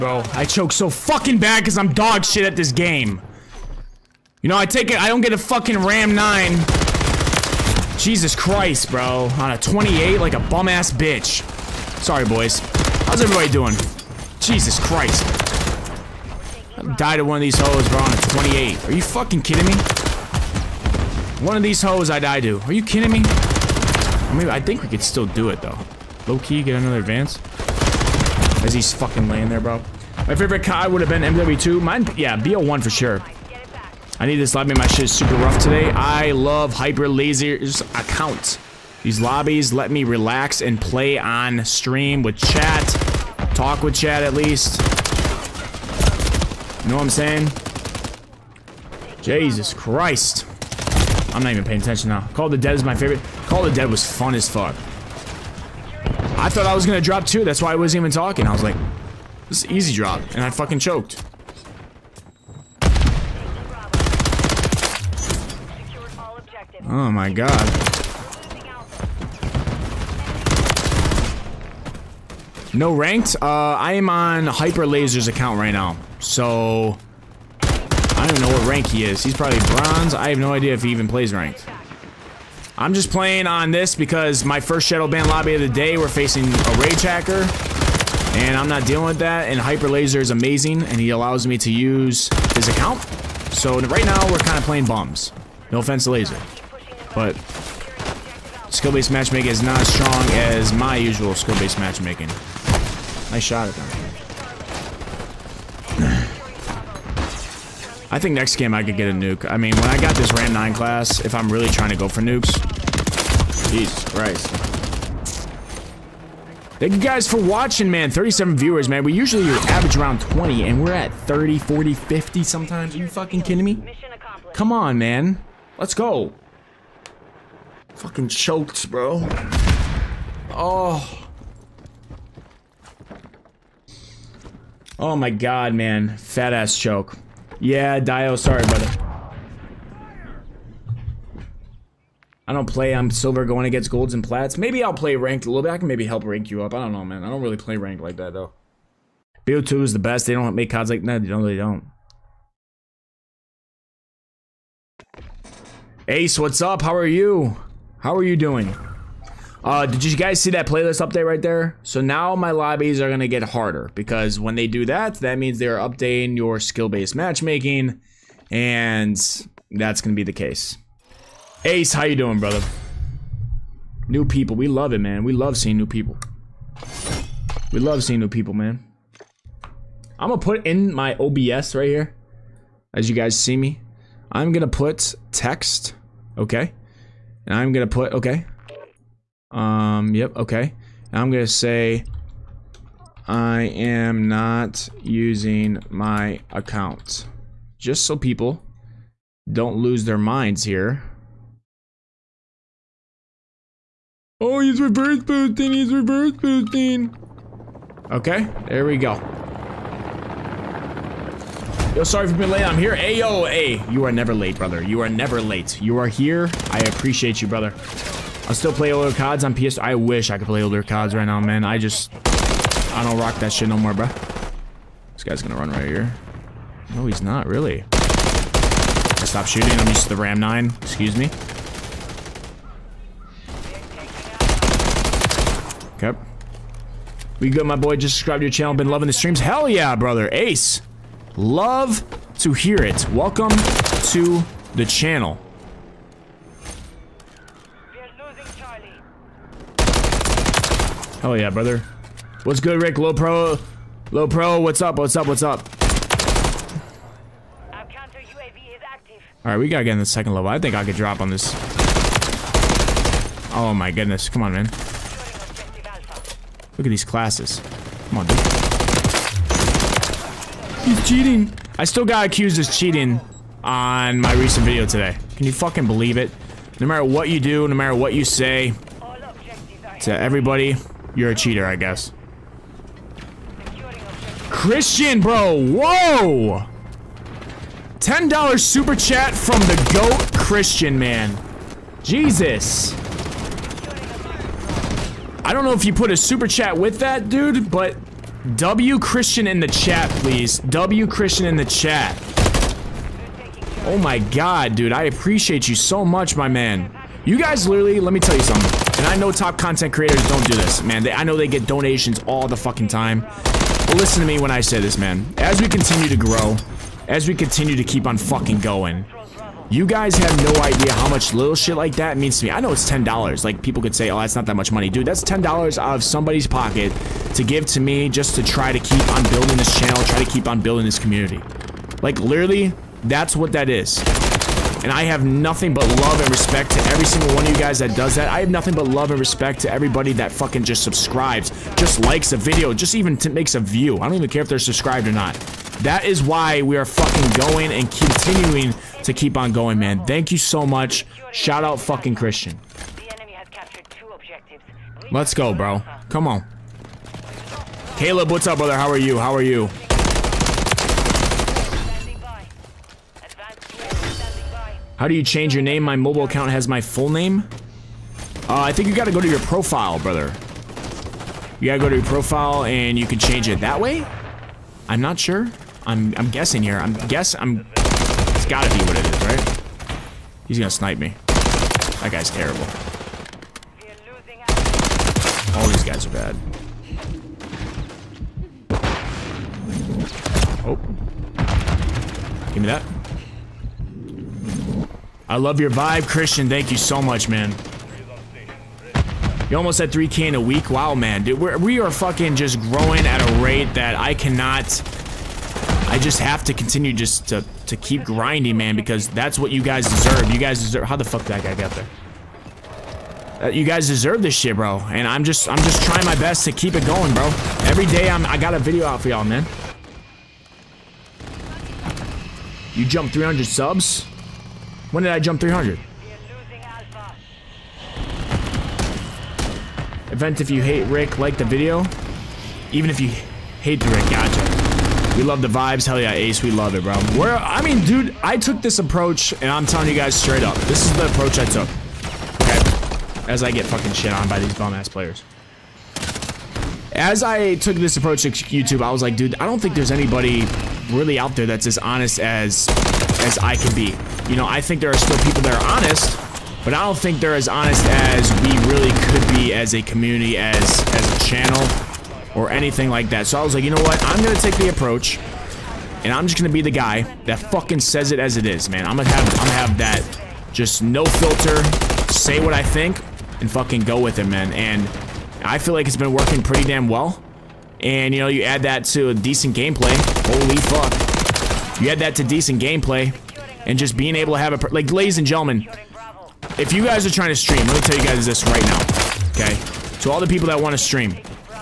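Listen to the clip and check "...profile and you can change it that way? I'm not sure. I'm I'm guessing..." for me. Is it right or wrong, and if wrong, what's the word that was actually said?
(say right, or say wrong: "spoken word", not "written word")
right.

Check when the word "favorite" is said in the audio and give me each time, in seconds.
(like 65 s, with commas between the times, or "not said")
30 s, 52 s.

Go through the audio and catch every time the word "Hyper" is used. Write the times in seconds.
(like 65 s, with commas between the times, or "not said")
36 s, 74 s, 89 s.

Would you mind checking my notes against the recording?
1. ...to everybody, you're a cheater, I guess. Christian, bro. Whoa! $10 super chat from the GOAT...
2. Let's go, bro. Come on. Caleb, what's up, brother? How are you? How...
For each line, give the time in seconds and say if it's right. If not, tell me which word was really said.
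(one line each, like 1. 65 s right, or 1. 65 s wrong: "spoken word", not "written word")
1. 280 s right
2. 355 s right.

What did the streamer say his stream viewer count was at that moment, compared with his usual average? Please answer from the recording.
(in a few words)
37.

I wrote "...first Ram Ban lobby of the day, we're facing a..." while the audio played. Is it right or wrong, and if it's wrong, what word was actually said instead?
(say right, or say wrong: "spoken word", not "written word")
wrong: "Shadow", not "Ram".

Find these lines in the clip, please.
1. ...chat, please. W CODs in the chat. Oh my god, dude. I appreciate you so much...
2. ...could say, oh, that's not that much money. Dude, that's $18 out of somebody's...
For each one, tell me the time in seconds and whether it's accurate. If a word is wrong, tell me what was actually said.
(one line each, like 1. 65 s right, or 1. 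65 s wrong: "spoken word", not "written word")
1. 299 s wrong: "Christian", not "CODs"
2. 323 s wrong: "10", not "18".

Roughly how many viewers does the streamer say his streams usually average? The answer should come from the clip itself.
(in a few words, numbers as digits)
20.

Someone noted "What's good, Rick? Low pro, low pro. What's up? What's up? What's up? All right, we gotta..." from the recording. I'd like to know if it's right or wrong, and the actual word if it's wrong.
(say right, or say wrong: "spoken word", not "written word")
right.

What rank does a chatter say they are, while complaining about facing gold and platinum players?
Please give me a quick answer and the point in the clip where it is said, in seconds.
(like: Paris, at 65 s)
silver, at 142 s.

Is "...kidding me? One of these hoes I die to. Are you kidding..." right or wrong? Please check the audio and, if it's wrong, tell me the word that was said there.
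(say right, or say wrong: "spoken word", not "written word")
right.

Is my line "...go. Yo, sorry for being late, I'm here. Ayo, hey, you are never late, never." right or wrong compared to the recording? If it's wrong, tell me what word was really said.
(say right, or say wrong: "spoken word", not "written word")
wrong: "brother", not "never".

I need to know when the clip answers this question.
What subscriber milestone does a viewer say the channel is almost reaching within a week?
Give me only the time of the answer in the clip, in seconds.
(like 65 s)
399 s.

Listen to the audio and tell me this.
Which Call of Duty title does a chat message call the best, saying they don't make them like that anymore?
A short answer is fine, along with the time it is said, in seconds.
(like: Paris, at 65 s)
BO2, at 149 s.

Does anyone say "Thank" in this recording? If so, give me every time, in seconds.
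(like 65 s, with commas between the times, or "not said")
116 s, 350 s, 396 s.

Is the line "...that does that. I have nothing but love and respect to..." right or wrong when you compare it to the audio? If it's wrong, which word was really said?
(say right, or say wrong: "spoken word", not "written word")
right.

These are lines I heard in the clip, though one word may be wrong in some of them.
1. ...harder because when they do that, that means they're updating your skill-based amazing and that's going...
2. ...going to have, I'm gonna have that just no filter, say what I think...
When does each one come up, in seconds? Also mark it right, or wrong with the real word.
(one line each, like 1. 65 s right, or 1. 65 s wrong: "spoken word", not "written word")
1. 163 s wrong: "matchmaking", not "amazing"
2. 468 s right.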